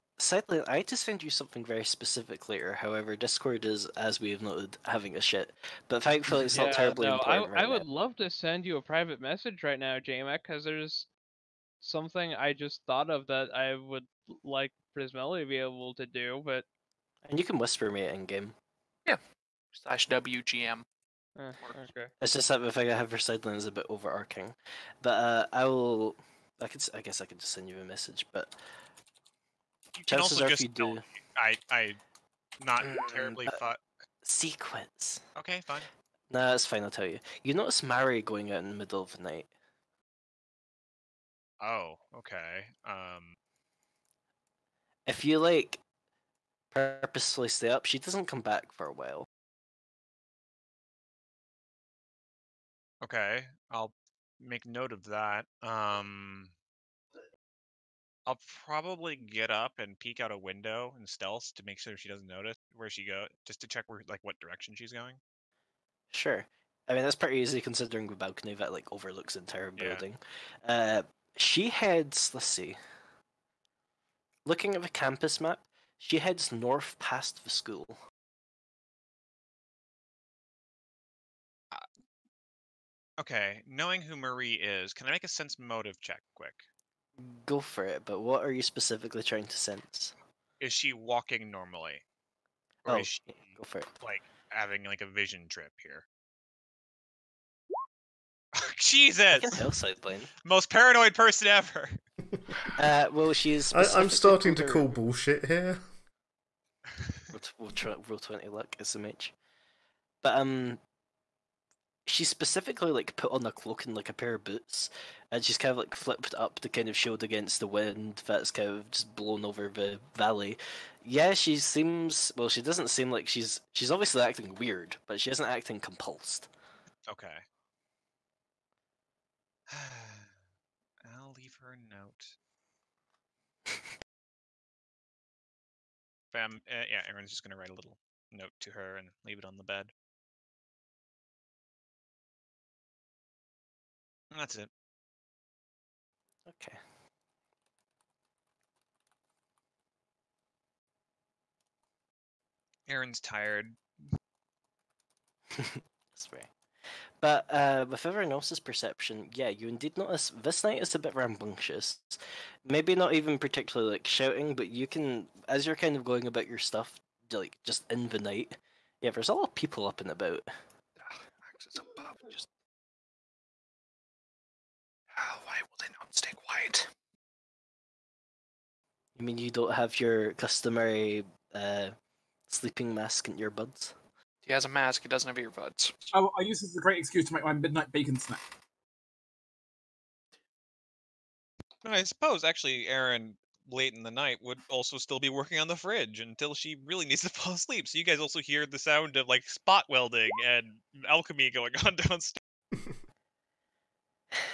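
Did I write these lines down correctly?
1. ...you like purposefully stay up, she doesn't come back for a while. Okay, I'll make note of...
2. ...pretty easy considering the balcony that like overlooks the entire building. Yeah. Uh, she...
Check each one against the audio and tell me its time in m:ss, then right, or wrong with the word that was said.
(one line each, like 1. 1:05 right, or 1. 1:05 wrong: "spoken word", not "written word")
1. 0:45 right
2. 1:07 right.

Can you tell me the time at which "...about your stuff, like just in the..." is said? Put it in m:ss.
2:46.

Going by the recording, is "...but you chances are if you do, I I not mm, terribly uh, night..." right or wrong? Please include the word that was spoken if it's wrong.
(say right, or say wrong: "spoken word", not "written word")
wrong: "thought", not "night".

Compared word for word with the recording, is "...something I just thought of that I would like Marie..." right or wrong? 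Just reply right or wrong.
wrong.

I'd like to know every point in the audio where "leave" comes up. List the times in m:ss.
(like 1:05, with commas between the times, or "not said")
2:11, 2:19.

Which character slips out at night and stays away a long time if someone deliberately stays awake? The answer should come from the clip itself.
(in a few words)
Mary.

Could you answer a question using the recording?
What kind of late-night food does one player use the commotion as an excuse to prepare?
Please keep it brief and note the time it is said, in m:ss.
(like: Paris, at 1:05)
Bacon snack, at 3:07.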